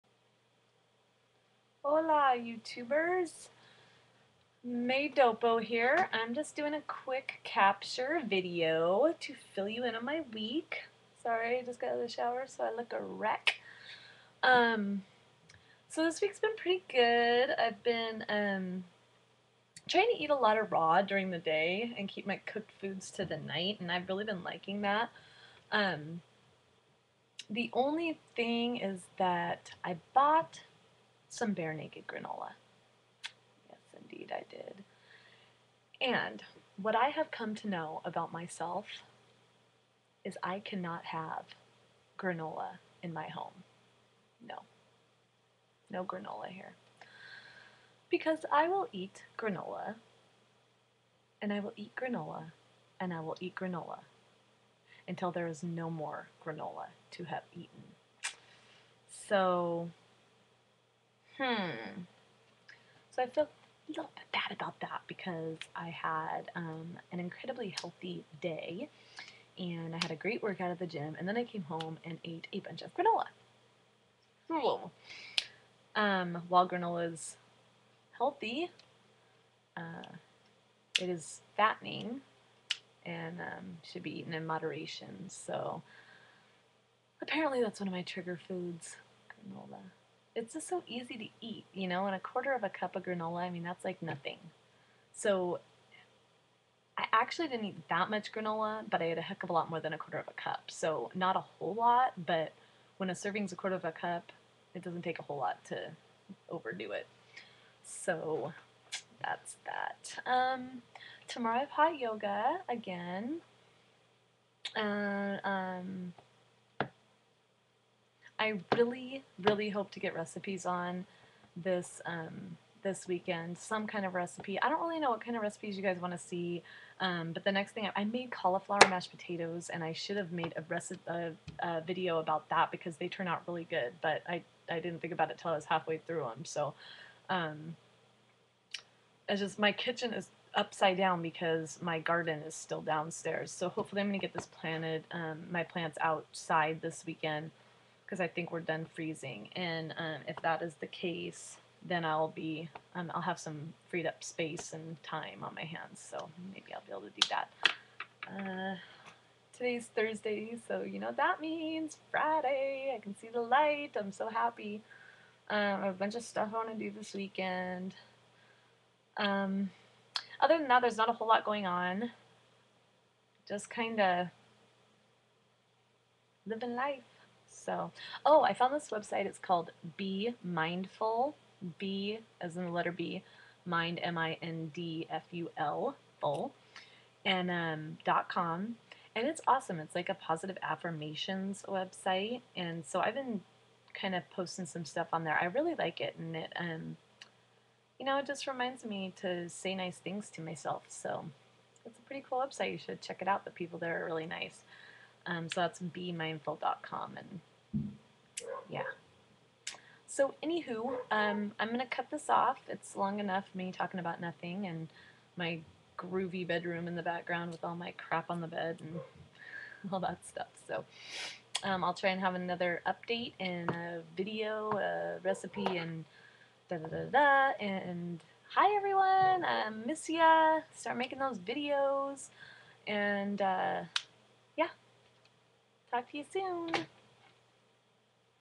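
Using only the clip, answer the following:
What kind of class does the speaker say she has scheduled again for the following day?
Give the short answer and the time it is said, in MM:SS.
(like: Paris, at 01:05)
Hot yoga, at 01:51.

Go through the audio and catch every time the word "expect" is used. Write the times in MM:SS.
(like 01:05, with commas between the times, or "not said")
not said.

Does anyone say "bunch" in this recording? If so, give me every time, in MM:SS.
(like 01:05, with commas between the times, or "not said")
01:12, 02:45.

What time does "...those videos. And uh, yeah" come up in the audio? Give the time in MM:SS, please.
03:51.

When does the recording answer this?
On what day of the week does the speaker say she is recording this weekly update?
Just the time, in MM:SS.
02:39.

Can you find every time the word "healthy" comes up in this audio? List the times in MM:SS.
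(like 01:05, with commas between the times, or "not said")
01:07, 01:18.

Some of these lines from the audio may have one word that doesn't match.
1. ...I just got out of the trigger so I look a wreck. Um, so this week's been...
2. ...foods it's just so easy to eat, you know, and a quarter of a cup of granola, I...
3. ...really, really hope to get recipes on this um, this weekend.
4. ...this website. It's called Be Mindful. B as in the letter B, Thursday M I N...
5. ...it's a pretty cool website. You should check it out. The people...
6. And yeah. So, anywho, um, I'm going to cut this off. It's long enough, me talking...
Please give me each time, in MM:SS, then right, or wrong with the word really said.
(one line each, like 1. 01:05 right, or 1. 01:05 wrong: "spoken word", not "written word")
1. 00:11 wrong: "shower", not "trigger"
2. 01:28 right
3. 01:58 right
4. 02:58 wrong: "Mind", not "Thursday"
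5. 03:21 right
6. 03:27 right.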